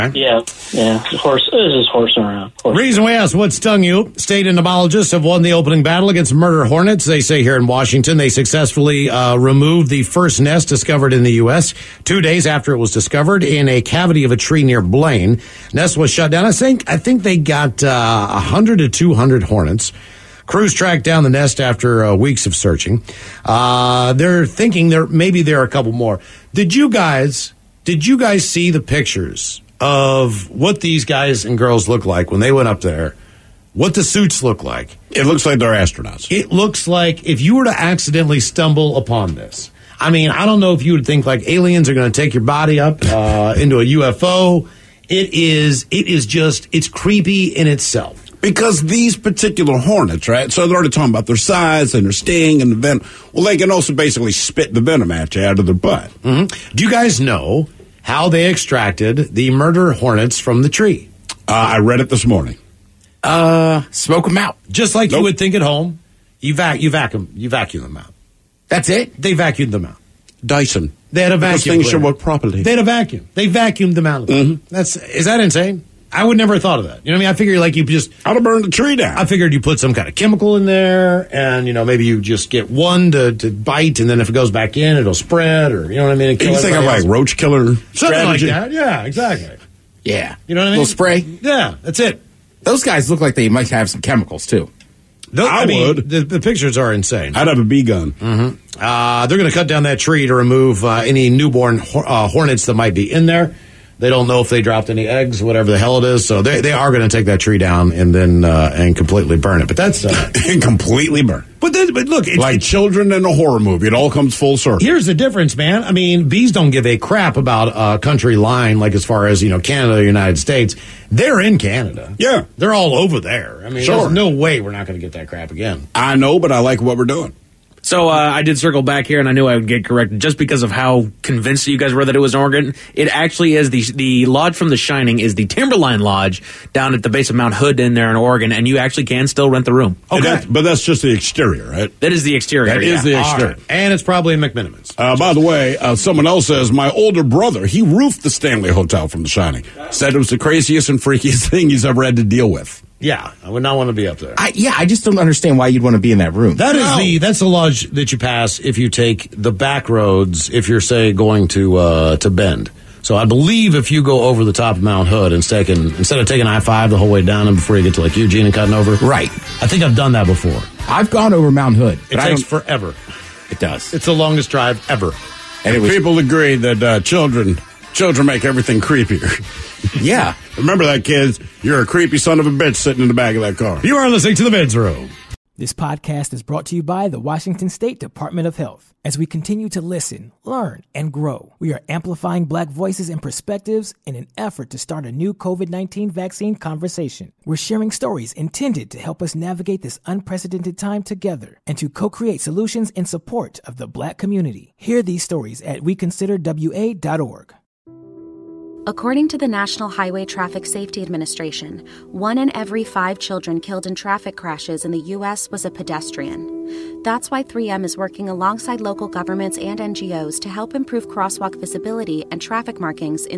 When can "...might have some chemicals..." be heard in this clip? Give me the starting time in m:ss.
1:33.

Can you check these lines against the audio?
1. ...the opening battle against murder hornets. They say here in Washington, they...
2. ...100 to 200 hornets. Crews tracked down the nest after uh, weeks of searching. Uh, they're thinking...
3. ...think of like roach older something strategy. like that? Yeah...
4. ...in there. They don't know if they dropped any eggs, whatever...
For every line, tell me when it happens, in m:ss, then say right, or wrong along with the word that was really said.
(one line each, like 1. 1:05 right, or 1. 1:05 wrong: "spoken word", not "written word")
1. 0:05 right
2. 0:18 right
3. 1:26 wrong: "killer", not "older"
4. 1:43 right.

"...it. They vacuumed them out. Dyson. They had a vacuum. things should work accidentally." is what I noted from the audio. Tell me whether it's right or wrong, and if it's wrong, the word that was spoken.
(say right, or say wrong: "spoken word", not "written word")
wrong: "properly", not "accidentally".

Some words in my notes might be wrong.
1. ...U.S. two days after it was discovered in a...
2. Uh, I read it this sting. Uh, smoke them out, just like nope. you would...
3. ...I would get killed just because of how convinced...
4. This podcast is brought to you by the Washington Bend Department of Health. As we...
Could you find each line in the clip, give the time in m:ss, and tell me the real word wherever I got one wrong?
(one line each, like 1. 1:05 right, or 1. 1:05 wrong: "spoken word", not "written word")
1. 0:11 right
2. 1:01 wrong: "morning", not "sting"
3. 2:09 wrong: "corrected", not "killed"
4. 3:05 wrong: "State", not "Bend".